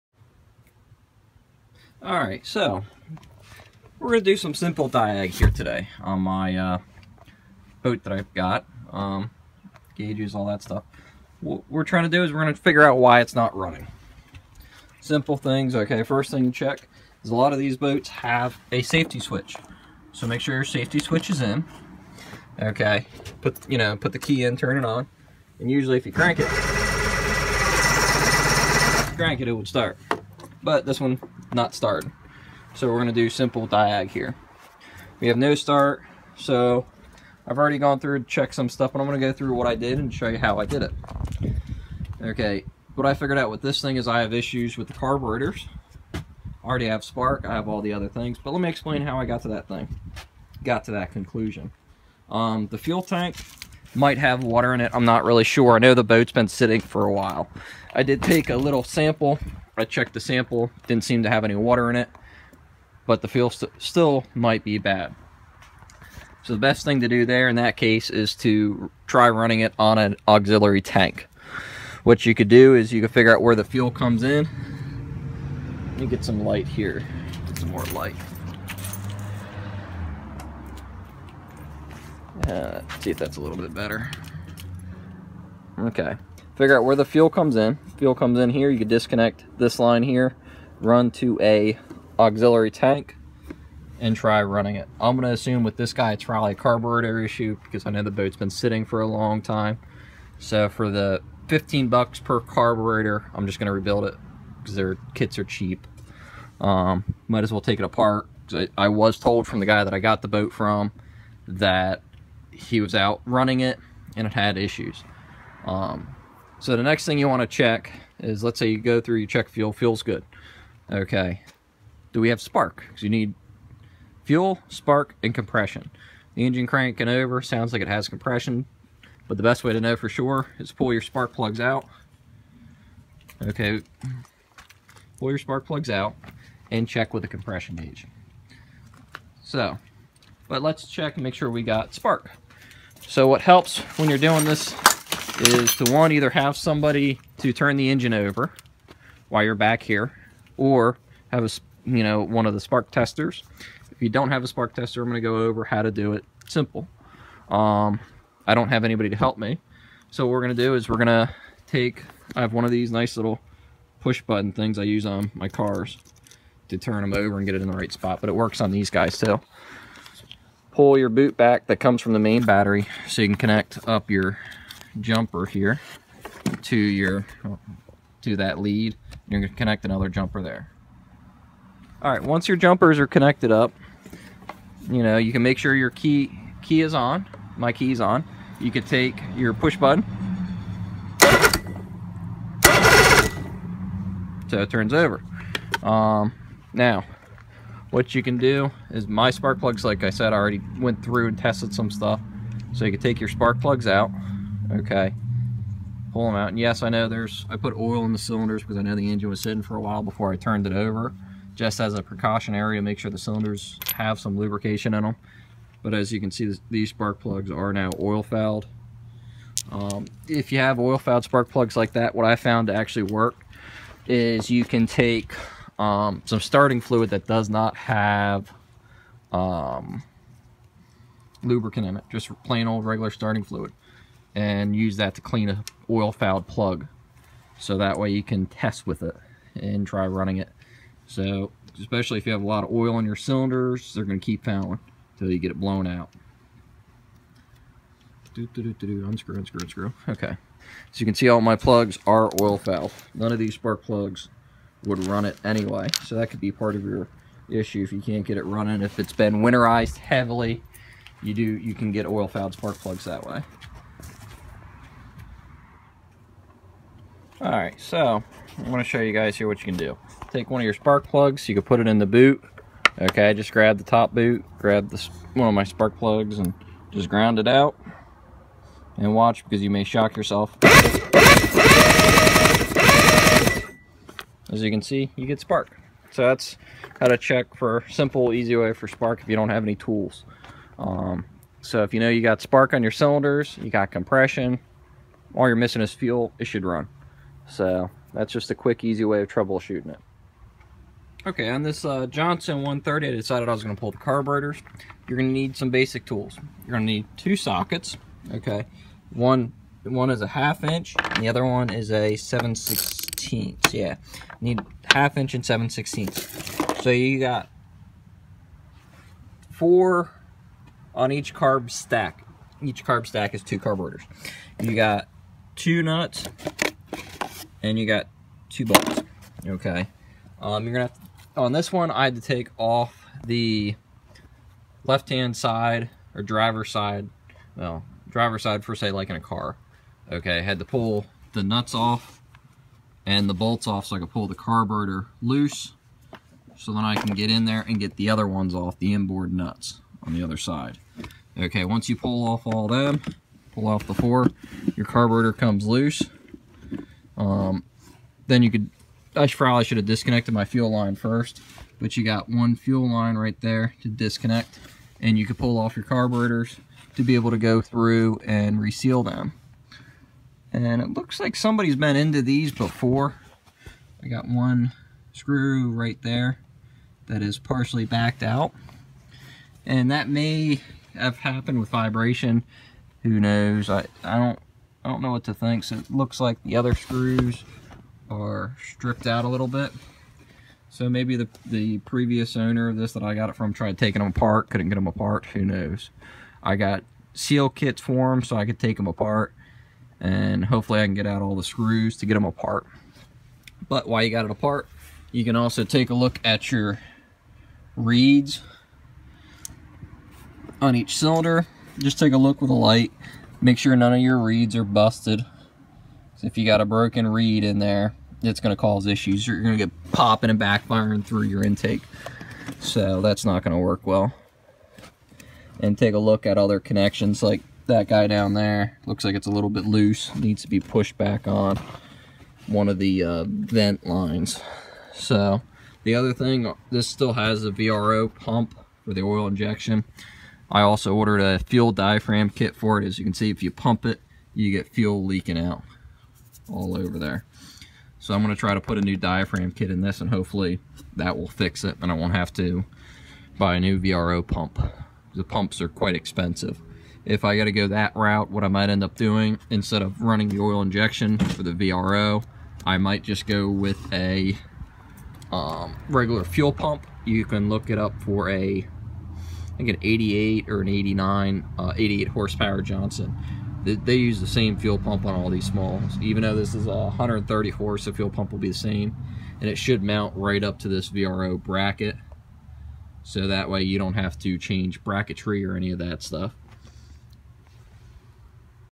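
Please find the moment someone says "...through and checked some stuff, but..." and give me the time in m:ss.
0:37.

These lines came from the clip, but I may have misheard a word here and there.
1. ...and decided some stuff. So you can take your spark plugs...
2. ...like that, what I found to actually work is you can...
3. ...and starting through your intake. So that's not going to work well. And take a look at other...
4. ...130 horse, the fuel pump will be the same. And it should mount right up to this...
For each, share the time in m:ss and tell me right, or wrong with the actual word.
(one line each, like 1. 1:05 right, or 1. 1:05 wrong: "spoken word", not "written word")
1. 3:21 wrong: "tested", not "decided"
2. 3:41 right
3. 7:00 wrong: "backfiring", not "starting"
4. 7:56 right.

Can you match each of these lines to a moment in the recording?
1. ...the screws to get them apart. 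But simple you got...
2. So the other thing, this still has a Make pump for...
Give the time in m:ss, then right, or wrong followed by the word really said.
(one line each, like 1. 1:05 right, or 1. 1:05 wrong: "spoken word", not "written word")
1. 6:41 wrong: "while", not "simple"
2. 7:14 wrong: "VRO", not "Make".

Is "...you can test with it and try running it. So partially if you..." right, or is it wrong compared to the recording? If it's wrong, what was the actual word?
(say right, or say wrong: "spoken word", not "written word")
wrong: "especially", not "partially".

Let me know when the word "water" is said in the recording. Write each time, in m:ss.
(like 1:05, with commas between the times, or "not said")
0:54, 1:01.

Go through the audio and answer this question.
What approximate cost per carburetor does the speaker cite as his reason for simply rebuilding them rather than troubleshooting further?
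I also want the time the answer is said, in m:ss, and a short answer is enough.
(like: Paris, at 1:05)
$15, at 1:41.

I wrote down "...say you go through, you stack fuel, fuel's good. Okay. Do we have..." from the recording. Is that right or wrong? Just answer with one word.
wrong.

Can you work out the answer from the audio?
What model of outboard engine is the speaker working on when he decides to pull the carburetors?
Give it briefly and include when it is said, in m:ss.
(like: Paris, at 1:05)
Johnson 130, at 5:02.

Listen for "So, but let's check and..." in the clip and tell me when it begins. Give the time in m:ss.
2:19.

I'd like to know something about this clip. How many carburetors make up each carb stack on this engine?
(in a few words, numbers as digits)
2.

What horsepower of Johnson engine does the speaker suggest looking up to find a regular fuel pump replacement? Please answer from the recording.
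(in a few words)
88 horsepower.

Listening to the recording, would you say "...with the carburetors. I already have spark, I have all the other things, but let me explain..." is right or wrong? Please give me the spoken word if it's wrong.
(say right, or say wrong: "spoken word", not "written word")
right.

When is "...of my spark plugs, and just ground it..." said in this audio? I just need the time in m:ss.
4:35.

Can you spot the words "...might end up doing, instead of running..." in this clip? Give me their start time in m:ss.
7:38.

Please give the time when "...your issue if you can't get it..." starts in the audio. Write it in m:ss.
4:16.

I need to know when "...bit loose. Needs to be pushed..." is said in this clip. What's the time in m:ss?
7:09.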